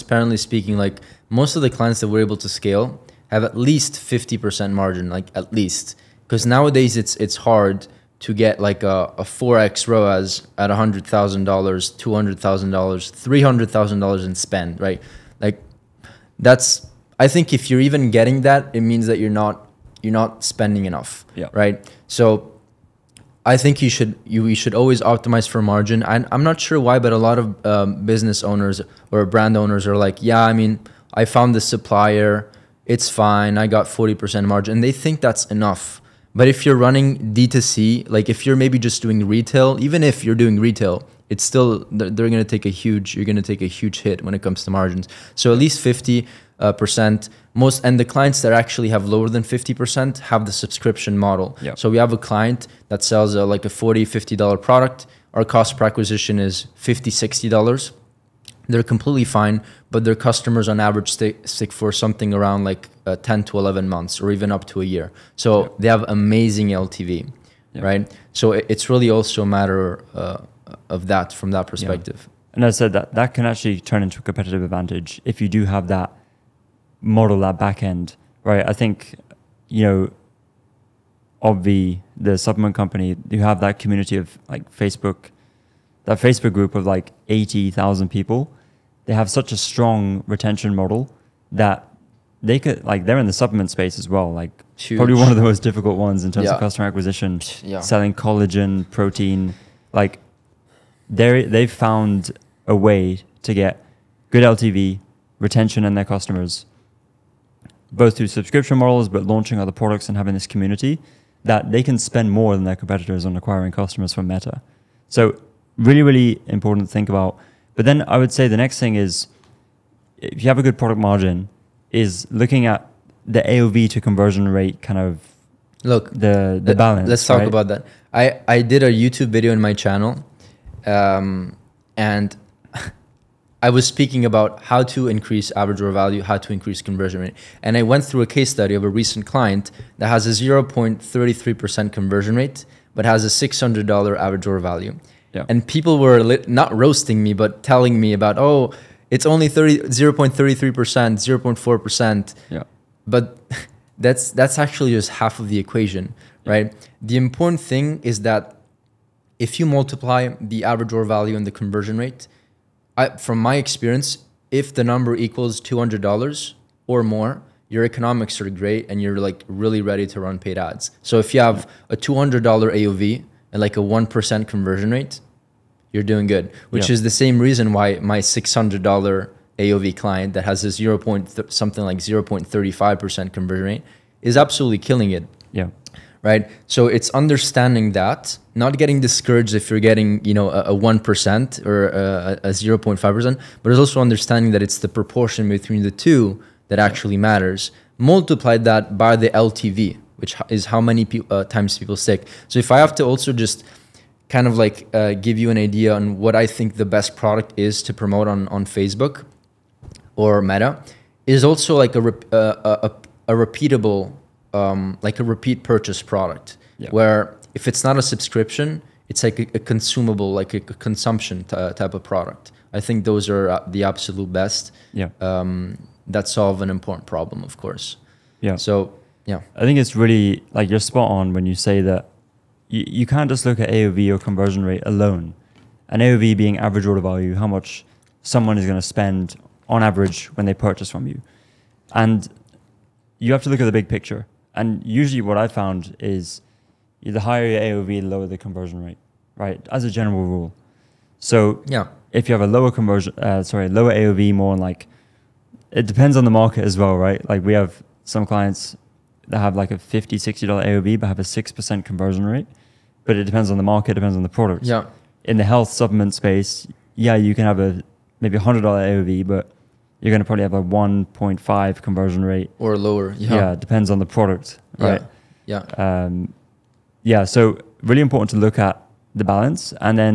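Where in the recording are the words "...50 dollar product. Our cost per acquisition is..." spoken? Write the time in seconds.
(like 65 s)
54 s.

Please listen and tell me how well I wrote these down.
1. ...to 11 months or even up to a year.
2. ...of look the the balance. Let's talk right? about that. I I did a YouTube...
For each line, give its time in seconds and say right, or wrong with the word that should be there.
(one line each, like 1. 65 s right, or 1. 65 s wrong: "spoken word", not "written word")
1. 63 s right
2. 124 s right.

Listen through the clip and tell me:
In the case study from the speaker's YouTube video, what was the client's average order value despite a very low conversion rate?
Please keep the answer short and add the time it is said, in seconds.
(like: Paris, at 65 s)
$600, at 143 s.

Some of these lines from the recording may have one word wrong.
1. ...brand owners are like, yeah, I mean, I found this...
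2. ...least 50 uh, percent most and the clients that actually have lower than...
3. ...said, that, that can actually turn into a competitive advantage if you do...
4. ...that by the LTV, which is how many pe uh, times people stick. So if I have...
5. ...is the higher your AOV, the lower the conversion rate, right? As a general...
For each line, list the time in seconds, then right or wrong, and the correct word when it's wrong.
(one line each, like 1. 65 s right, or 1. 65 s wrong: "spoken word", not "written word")
1. 29 s right
2. 45 s right
3. 72 s right
4. 198 s right
5. 245 s right.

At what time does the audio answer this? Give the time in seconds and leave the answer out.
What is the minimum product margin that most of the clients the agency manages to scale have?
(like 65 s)
3 s.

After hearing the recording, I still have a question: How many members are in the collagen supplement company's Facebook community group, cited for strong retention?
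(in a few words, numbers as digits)
80,000.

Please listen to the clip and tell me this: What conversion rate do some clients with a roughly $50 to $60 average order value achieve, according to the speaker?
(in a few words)
6%.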